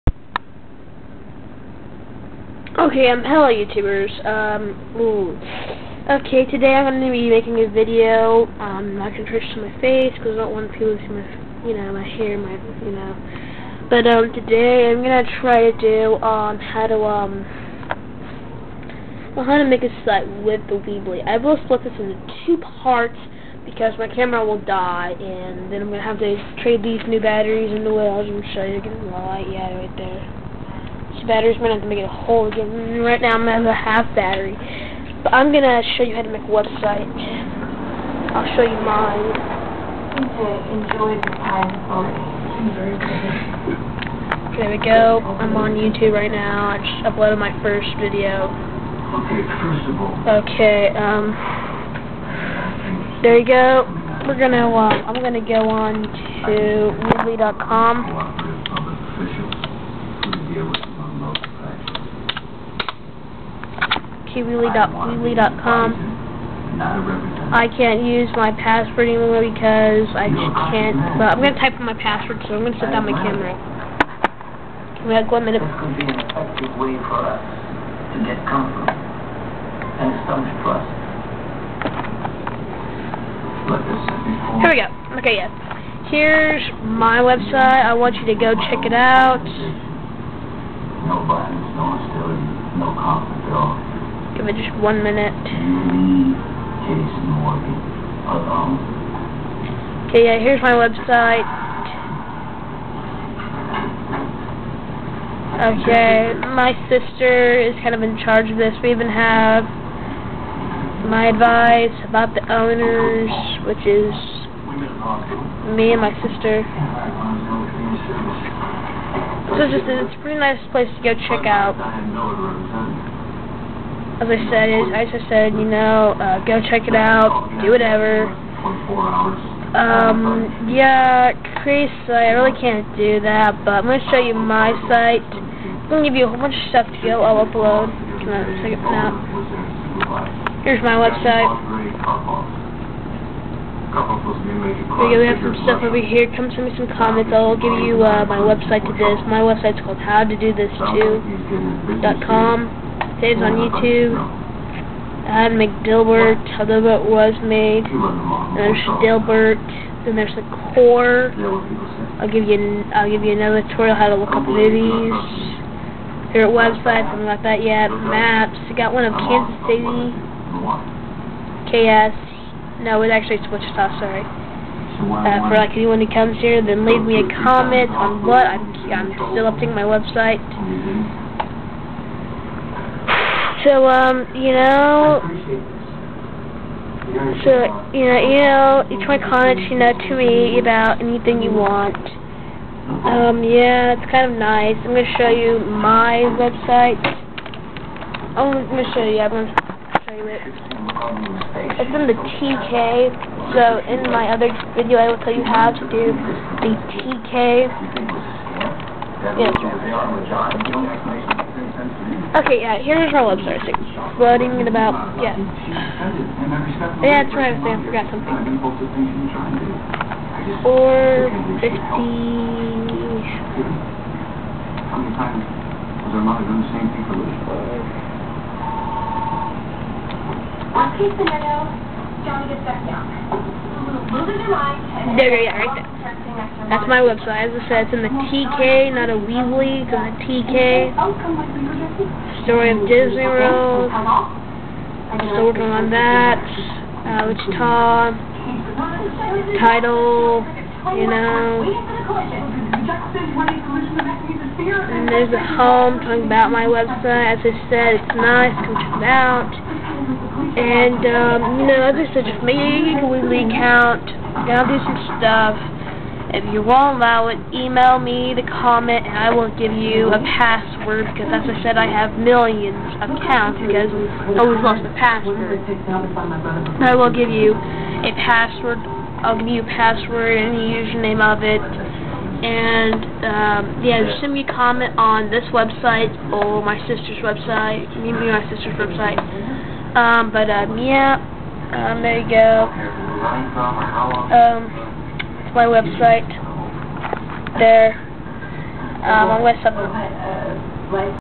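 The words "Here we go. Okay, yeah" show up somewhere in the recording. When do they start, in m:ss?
1:23.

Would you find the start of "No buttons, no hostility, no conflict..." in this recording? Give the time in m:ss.
1:31.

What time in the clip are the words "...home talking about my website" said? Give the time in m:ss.
4:15.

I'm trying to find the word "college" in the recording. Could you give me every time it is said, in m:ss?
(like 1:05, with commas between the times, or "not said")
3:09.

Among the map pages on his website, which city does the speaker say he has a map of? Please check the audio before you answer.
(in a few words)
Kansas City.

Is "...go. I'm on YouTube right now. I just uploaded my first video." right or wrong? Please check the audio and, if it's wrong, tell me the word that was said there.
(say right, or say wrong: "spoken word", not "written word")
right.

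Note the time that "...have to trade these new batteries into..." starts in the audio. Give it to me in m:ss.
0:26.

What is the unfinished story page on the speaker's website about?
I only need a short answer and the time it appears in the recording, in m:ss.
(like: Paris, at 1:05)
Disney World, at 4:02.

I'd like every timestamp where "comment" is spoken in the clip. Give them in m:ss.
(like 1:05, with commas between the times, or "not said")
2:26, 2:57, 4:28, 4:44.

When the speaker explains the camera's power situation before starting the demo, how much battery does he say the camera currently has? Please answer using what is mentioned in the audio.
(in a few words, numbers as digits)
half.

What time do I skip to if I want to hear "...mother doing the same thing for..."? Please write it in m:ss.
3:46.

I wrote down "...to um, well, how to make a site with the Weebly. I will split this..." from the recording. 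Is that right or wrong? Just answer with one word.
right.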